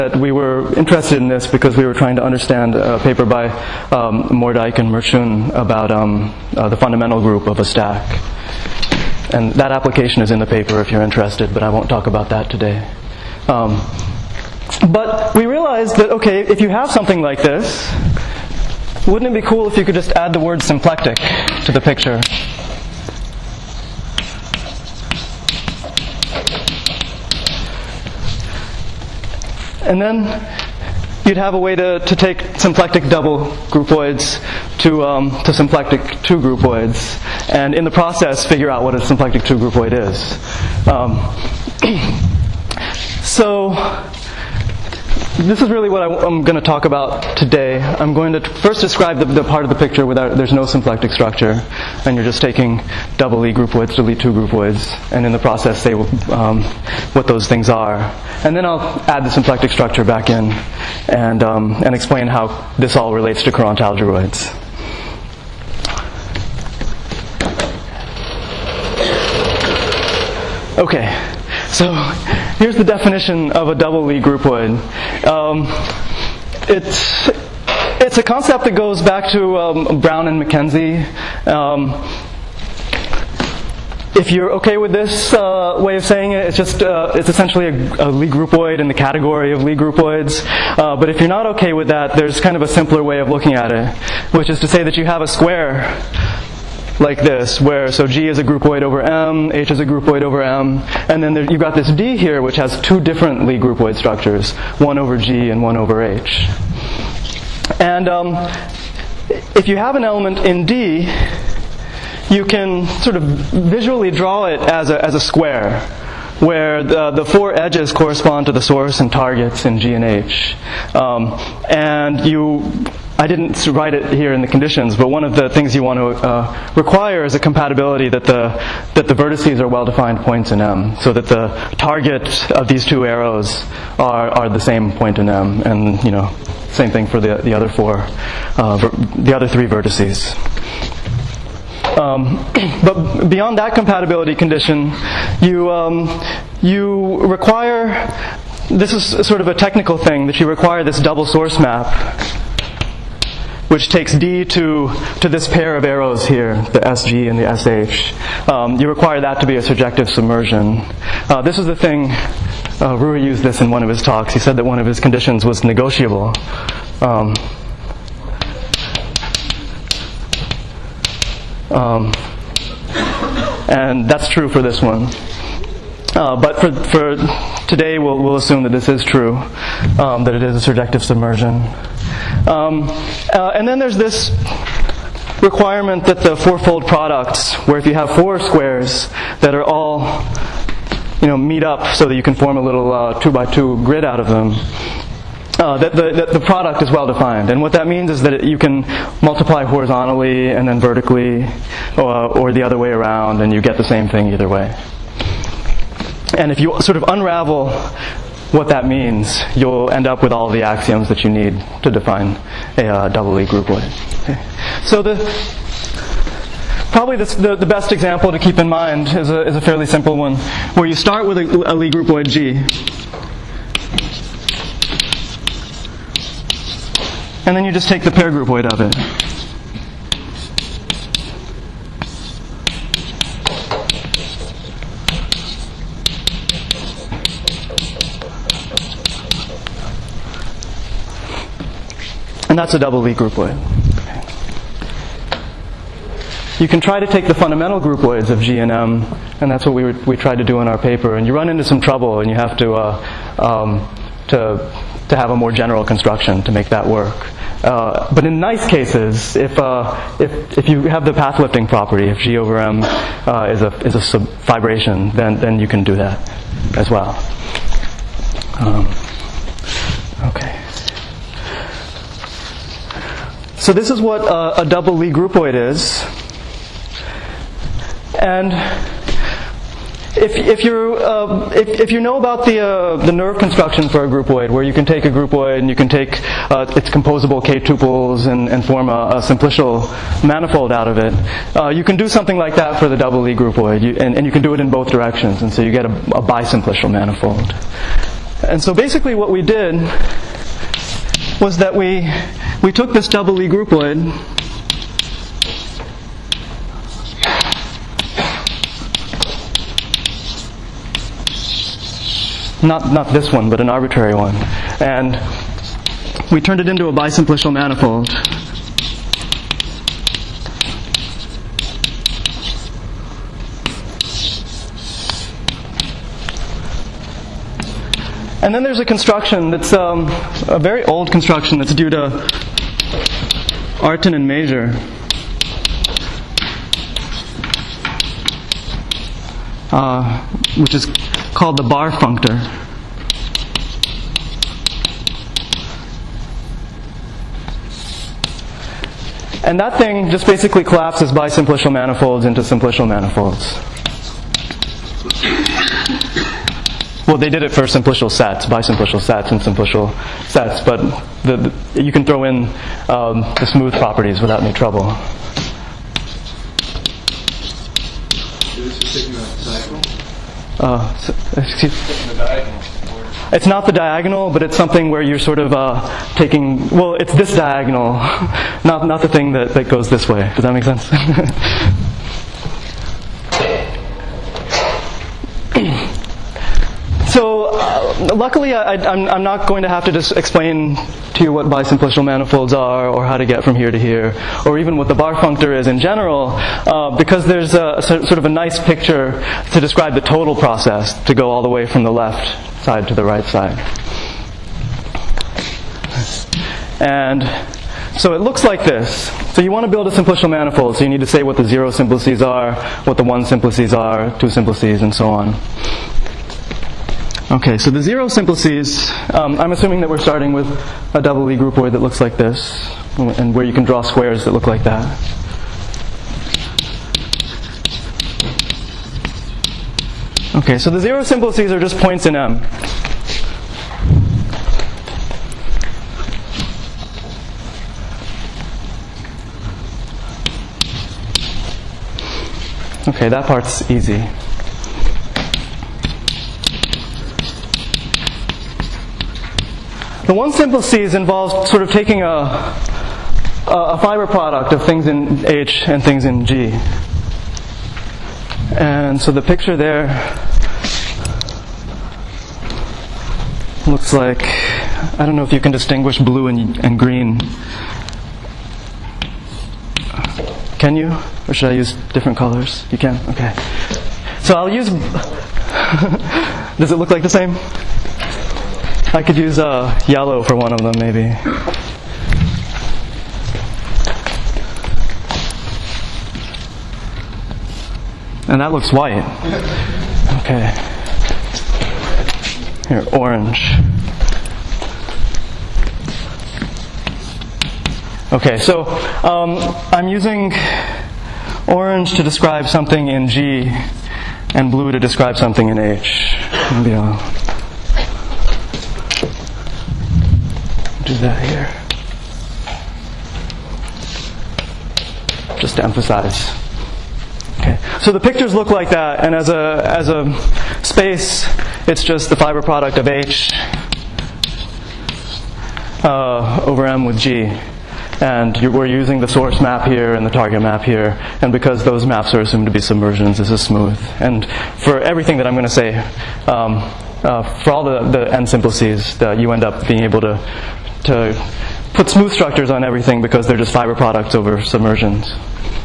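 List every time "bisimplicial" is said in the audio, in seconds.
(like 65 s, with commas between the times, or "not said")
296 s, 316 s, 351 s, 391 s.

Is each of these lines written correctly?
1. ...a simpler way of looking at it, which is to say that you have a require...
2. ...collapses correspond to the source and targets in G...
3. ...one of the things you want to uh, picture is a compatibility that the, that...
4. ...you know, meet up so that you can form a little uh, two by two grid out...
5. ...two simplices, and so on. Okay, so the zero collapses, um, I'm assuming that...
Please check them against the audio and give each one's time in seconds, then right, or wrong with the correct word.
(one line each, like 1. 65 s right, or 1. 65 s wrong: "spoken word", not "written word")
1. 92 s wrong: "square", not "require"
2. 117 s wrong: "edges", not "collapses"
3. 125 s wrong: "require", not "picture"
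4. 191 s right
5. 414 s wrong: "simplices", not "collapses".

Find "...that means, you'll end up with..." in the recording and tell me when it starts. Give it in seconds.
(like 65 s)
208 s.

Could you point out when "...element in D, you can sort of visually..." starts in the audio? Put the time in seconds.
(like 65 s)
110 s.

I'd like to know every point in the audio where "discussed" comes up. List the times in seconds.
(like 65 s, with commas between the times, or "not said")
not said.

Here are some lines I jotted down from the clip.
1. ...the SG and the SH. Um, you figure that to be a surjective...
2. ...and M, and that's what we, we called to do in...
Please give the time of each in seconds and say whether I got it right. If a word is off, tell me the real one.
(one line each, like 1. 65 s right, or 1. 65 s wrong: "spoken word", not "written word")
1. 156 s wrong: "require", not "figure"
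2. 248 s wrong: "tried", not "called".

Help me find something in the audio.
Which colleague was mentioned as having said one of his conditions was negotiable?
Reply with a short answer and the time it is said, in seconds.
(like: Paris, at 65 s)
Rui, at 162 s.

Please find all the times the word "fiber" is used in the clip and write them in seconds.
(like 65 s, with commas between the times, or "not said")
453 s, 522 s, 543 s.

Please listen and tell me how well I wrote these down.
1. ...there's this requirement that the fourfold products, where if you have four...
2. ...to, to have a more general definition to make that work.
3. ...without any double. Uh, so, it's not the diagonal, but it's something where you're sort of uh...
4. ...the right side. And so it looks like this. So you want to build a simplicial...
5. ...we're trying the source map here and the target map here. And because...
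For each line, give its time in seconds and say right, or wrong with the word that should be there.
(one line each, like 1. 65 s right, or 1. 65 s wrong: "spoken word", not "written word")
1. 183 s right
2. 254 s wrong: "construction", not "definition"
3. 364 s wrong: "trouble", not "double"
4. 402 s right
5. 528 s wrong: "using", not "trying".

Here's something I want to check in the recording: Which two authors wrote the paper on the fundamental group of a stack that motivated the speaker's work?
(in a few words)
Moerdijk and Mrčun.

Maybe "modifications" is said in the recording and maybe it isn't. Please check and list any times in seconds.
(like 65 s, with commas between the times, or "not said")
not said.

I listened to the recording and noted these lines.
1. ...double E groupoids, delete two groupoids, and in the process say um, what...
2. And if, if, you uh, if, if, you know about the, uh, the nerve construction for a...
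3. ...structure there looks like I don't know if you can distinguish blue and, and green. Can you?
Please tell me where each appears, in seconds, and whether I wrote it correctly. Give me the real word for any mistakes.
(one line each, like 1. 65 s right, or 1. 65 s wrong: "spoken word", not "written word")
1. 53 s right
2. 278 s right
3. 459 s wrong: "picture", not "structure".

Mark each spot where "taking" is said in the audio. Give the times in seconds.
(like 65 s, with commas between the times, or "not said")
52 s, 376 s, 451 s.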